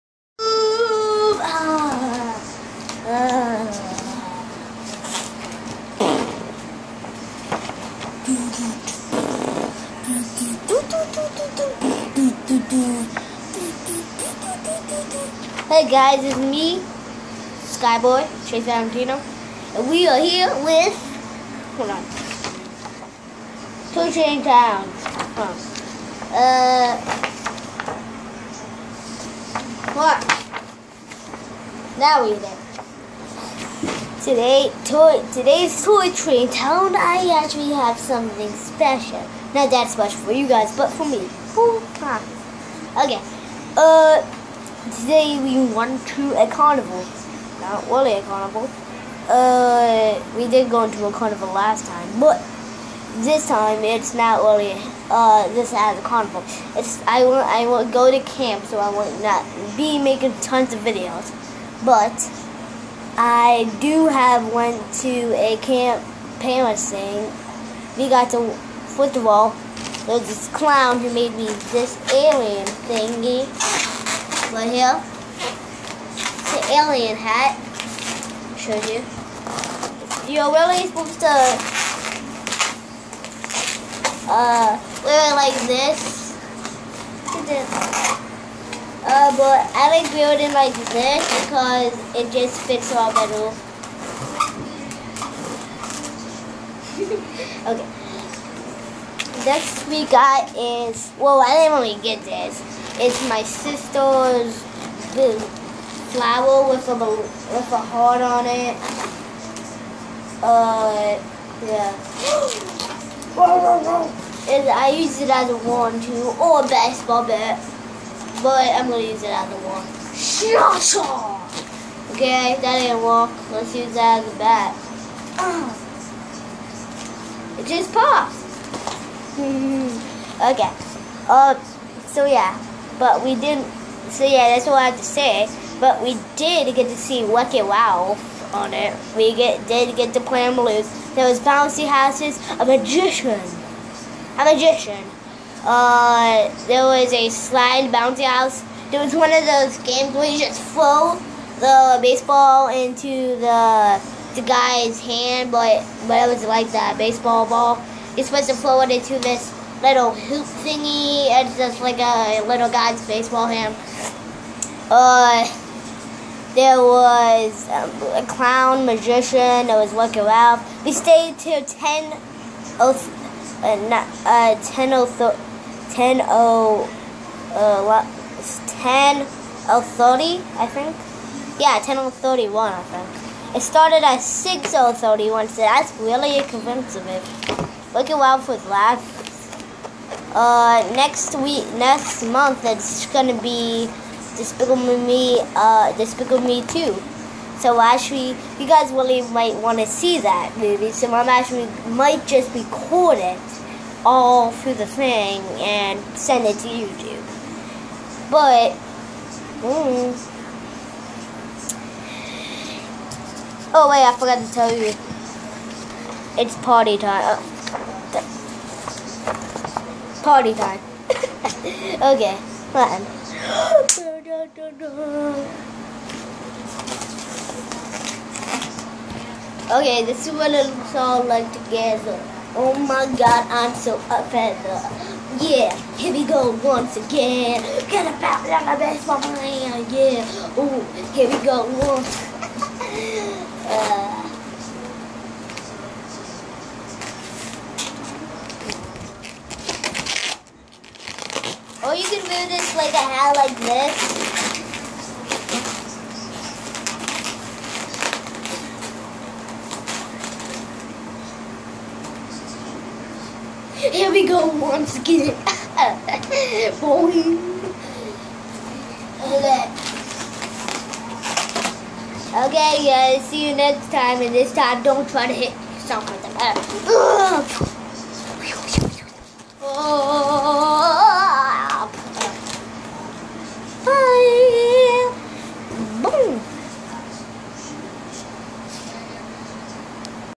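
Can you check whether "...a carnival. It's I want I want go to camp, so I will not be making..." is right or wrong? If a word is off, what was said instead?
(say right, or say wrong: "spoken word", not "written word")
right.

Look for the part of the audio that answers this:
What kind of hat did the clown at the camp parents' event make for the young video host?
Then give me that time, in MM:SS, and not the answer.
01:16.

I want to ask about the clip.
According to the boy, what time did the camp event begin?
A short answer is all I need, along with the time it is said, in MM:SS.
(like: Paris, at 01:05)
6:31, at 03:04.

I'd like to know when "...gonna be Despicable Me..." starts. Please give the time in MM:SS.
03:13.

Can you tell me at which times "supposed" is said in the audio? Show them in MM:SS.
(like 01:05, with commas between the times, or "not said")
01:20, 02:38.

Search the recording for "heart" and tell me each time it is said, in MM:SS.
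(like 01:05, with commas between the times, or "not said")
01:47.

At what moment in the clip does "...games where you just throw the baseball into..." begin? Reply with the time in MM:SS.
02:29.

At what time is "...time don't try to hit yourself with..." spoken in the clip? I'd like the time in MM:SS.
04:34.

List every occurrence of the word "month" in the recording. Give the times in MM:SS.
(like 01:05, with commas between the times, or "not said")
03:12.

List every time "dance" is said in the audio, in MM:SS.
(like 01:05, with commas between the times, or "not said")
not said.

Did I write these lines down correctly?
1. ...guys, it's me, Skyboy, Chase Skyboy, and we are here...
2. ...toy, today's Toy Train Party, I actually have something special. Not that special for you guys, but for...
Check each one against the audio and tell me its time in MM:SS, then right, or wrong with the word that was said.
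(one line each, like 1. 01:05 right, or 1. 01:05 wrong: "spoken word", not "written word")
1. 00:15 wrong: "Valentino", not "Skyboy"
2. 00:34 wrong: "Town", not "Party".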